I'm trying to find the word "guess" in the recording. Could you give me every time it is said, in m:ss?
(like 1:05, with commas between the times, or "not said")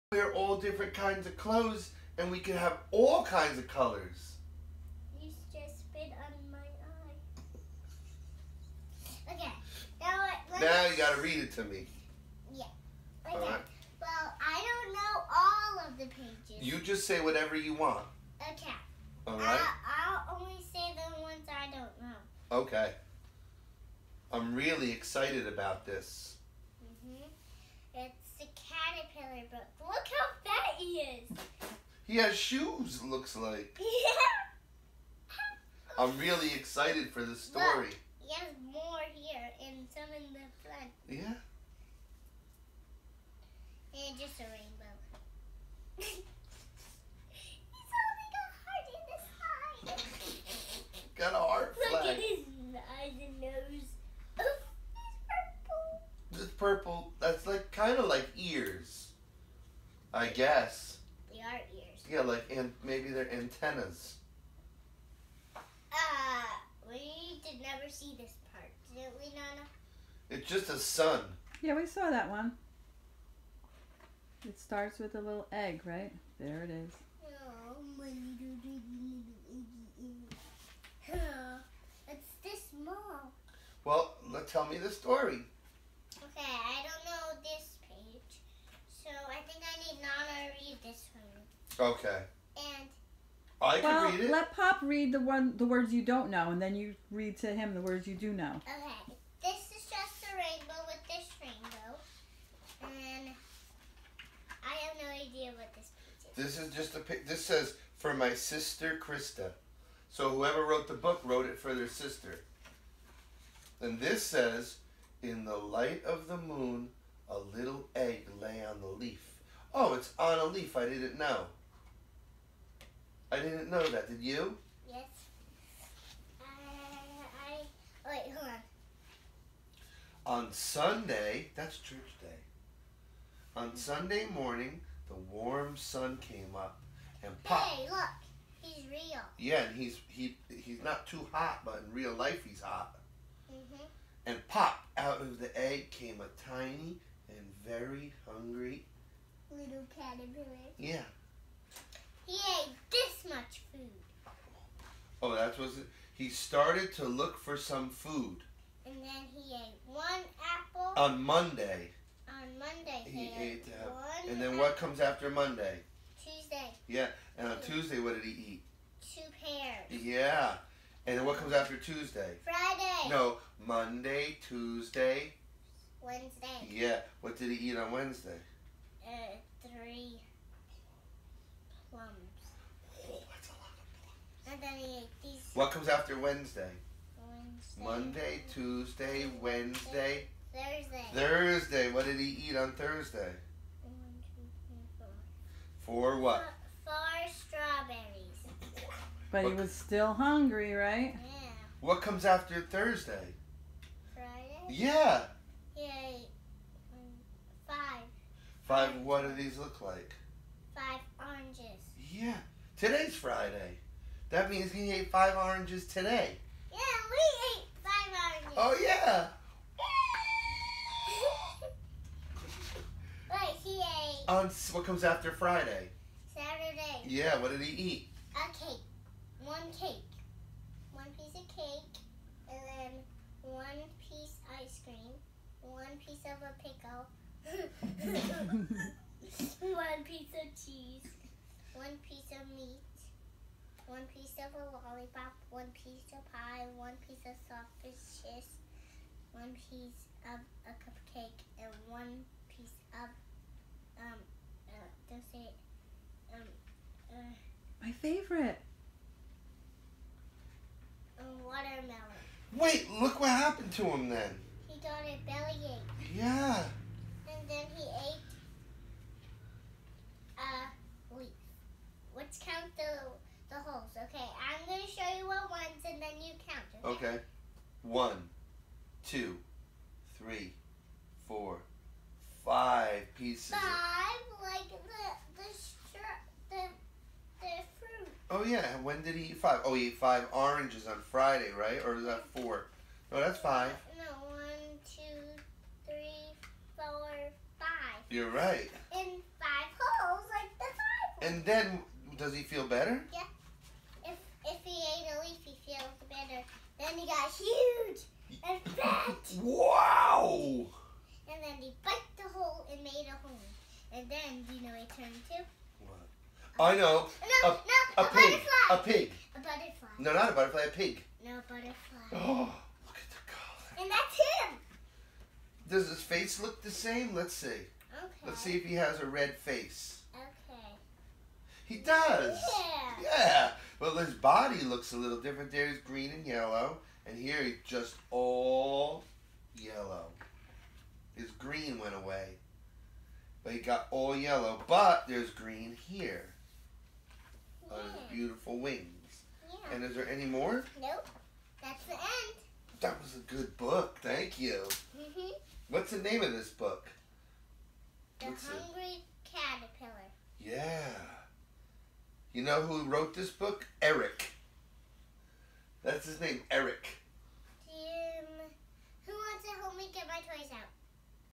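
1:00.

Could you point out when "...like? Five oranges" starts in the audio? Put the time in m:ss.
3:29.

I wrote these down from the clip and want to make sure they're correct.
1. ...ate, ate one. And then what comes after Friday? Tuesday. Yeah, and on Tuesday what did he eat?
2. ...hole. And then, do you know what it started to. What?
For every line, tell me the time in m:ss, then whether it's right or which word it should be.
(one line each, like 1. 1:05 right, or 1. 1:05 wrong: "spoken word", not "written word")
1. 2:43 wrong: "Monday", not "Friday"
2. 5:13 wrong: "turned", not "started".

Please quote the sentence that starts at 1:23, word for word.
Well, let, tell me the story.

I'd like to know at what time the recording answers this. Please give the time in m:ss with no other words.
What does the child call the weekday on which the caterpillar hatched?
2:11.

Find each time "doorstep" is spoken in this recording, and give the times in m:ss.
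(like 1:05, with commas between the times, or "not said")
not said.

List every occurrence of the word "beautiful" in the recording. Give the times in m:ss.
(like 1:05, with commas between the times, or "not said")
5:48.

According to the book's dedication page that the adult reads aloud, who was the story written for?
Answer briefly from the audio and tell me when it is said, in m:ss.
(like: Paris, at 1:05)
Christa, at 1:47.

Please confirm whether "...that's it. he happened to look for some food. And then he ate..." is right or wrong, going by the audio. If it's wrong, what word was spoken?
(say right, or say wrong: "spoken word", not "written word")
wrong: "started", not "happened".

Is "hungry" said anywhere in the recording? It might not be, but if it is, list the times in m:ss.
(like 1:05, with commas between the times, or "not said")
2:28, 3:20, 5:58.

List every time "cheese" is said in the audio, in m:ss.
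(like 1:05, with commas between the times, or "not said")
4:00, 4:07.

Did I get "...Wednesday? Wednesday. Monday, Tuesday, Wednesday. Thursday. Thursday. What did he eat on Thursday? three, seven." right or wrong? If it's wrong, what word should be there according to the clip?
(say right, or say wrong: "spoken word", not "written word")
wrong: "four", not "seven".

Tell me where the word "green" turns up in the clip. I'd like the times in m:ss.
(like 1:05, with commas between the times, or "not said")
5:35, 5:41, 5:45.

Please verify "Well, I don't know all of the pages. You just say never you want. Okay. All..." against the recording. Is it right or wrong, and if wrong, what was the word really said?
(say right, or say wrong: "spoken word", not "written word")
wrong: "whatever", not "never".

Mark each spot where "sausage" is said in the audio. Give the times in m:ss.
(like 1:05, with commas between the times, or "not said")
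4:07.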